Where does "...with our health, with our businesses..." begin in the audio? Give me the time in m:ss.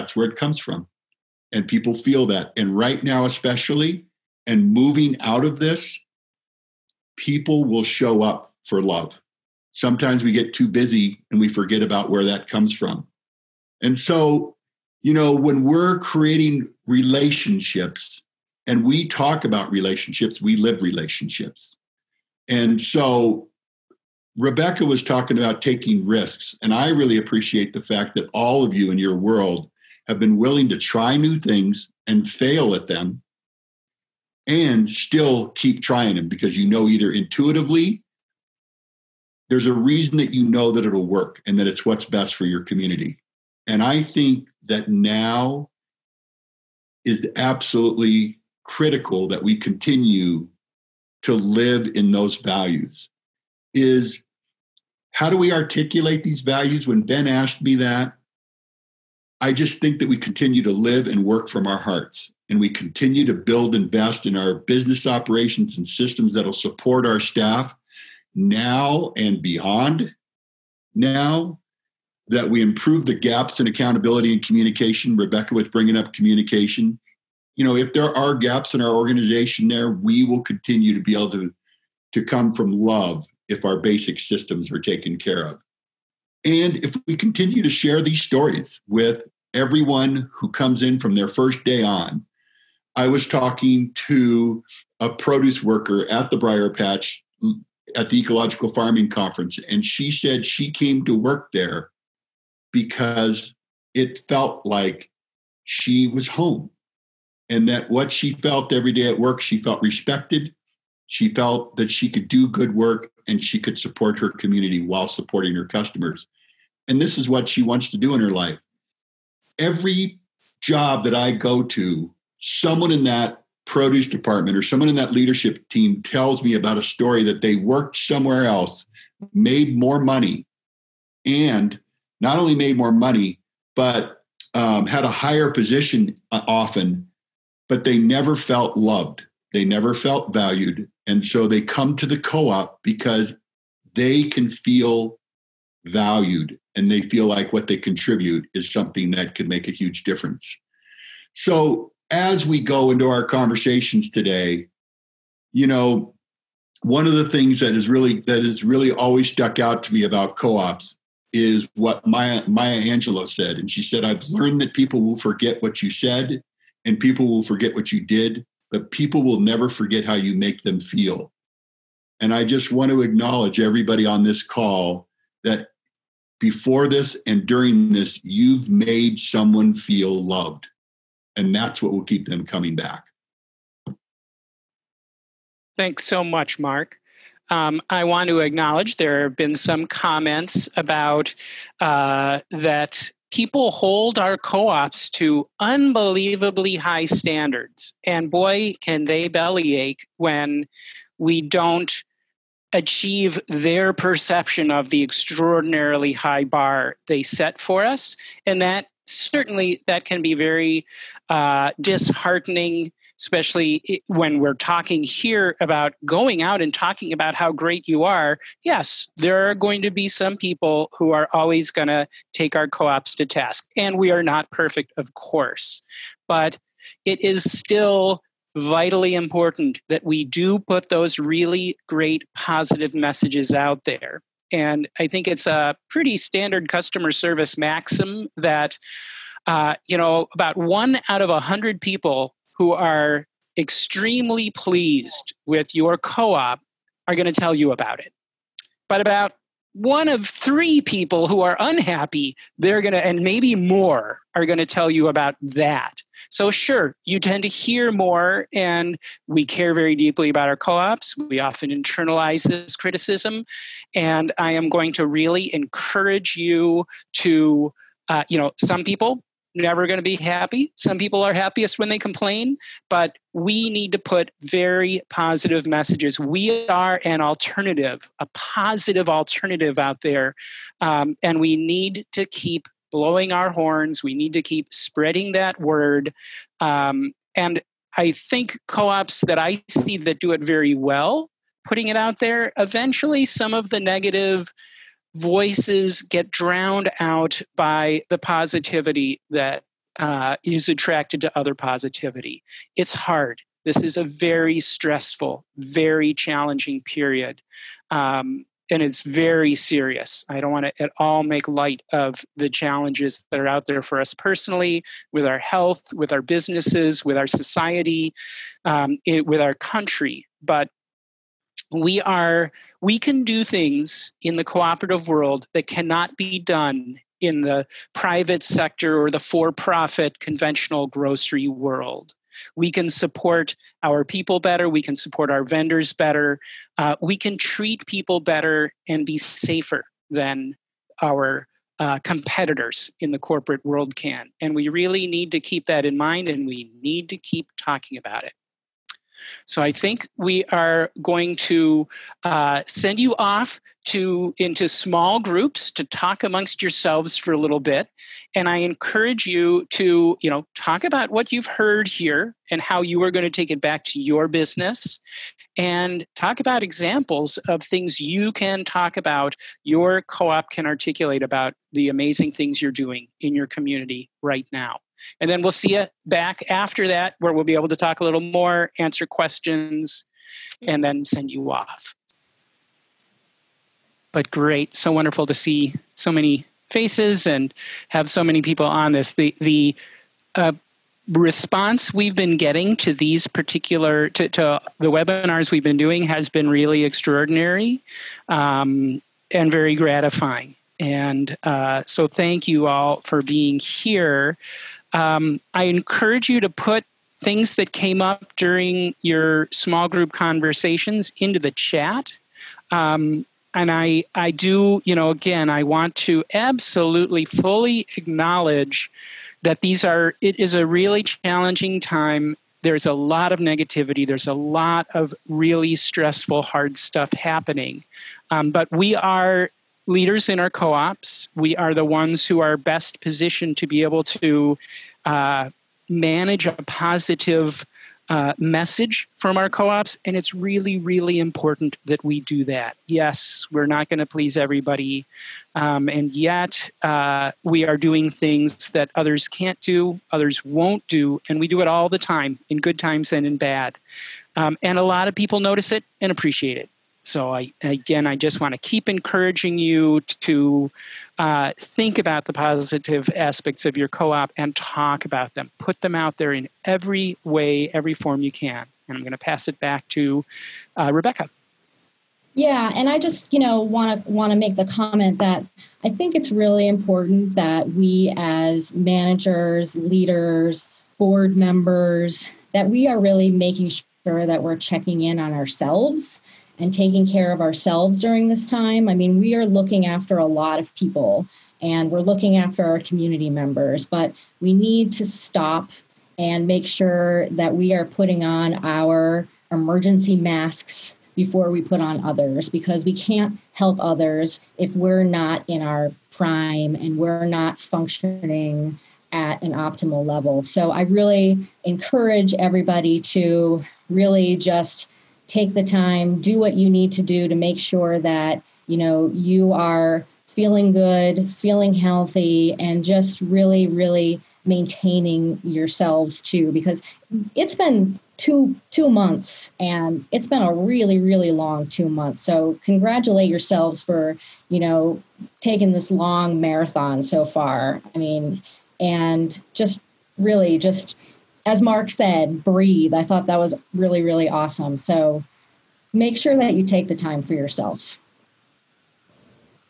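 5:15.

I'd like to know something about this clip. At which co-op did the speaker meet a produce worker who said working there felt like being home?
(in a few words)
Briar Patch.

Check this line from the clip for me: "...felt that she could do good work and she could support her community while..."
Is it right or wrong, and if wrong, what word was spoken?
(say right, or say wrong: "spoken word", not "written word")
right.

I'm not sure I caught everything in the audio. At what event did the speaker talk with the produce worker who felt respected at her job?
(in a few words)
Ecological Farming Conference.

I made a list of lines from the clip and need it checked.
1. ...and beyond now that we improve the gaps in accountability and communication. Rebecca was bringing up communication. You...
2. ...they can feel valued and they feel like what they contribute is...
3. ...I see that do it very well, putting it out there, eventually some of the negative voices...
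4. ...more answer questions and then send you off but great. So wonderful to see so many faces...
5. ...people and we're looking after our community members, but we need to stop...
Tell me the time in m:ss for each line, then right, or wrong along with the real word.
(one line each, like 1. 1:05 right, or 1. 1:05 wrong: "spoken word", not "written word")
1. 1:09 right
2. 2:23 right
3. 4:49 right
4. 6:18 right
5. 8:10 right.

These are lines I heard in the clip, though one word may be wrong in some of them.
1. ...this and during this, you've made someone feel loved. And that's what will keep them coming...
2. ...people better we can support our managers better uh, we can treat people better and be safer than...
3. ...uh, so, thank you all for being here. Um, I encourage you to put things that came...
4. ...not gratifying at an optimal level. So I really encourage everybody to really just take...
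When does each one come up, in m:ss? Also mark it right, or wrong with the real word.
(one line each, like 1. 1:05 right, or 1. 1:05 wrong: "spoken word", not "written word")
1. 2:56 right
2. 5:34 wrong: "vendors", not "managers"
3. 6:41 right
4. 8:27 wrong: "functioning", not "gratifying".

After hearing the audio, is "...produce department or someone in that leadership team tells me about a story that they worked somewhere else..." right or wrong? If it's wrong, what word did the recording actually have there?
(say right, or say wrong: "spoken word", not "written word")
right.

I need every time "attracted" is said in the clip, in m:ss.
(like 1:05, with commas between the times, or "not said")
5:00.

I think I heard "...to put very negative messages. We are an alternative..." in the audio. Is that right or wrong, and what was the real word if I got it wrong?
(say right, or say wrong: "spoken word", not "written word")
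wrong: "positive", not "negative".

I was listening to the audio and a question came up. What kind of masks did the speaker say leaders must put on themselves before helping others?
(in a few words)
emergency masks.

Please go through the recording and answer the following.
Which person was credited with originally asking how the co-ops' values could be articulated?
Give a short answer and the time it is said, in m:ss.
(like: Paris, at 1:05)
Ben, at 0:57.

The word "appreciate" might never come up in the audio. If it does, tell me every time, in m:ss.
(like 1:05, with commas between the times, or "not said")
0:27, 7:36.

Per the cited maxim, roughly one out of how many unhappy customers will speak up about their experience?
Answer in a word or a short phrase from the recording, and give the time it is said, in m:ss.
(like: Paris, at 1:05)
3, at 4:10.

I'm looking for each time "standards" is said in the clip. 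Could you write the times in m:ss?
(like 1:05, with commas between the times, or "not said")
3:17, 3:56.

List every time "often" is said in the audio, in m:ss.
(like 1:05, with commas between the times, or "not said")
2:16, 4:21.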